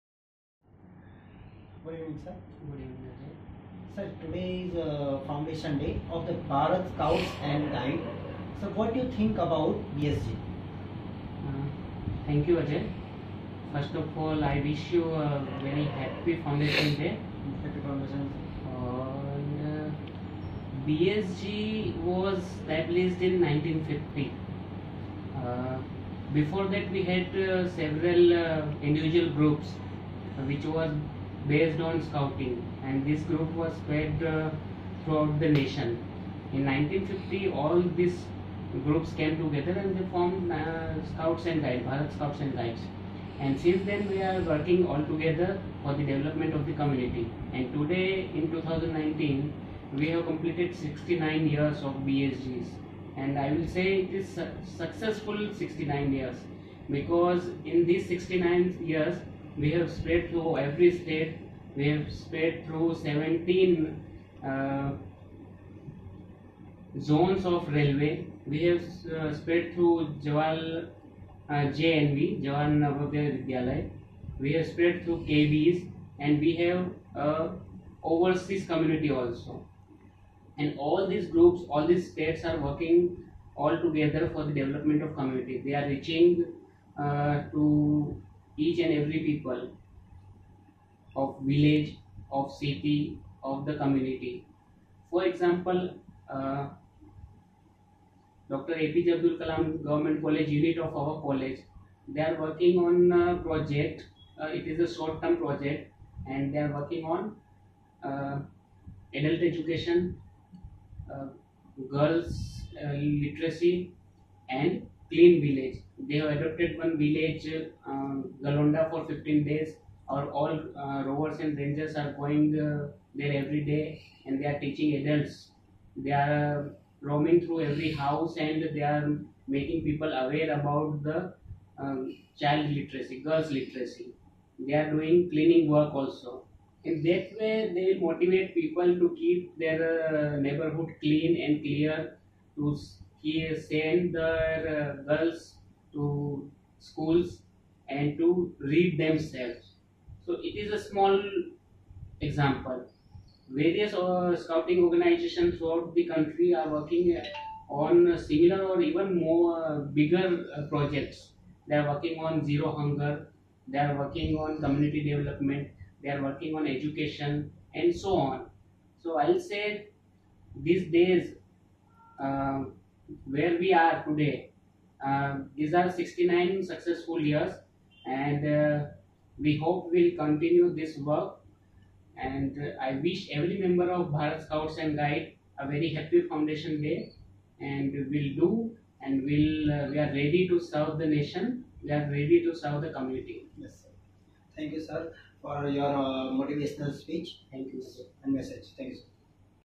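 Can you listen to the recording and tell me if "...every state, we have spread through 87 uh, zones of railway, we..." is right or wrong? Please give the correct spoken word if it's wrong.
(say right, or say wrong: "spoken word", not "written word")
wrong: "17", not "87".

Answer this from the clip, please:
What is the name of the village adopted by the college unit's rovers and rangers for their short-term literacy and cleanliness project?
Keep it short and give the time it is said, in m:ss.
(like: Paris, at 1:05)
Galonda, at 1:58.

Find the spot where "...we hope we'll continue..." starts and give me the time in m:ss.
2:59.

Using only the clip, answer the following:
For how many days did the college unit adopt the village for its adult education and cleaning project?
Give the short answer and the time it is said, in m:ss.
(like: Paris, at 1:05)
15 days, at 1:59.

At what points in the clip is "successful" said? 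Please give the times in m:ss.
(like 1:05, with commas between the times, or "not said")
0:54, 2:56.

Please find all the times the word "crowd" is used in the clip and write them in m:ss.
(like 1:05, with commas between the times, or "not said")
not said.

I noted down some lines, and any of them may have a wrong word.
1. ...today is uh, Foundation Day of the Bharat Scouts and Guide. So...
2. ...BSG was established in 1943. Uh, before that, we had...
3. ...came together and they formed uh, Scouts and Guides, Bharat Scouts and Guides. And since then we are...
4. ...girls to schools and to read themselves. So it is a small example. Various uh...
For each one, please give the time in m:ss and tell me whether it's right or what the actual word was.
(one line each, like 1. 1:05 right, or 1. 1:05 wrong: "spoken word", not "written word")
1. 0:04 right
2. 0:20 wrong: "1950", not "1943"
3. 0:39 right
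4. 2:25 right.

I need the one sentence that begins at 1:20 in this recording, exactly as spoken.
And all these groups, all these states are working all together for the development of community.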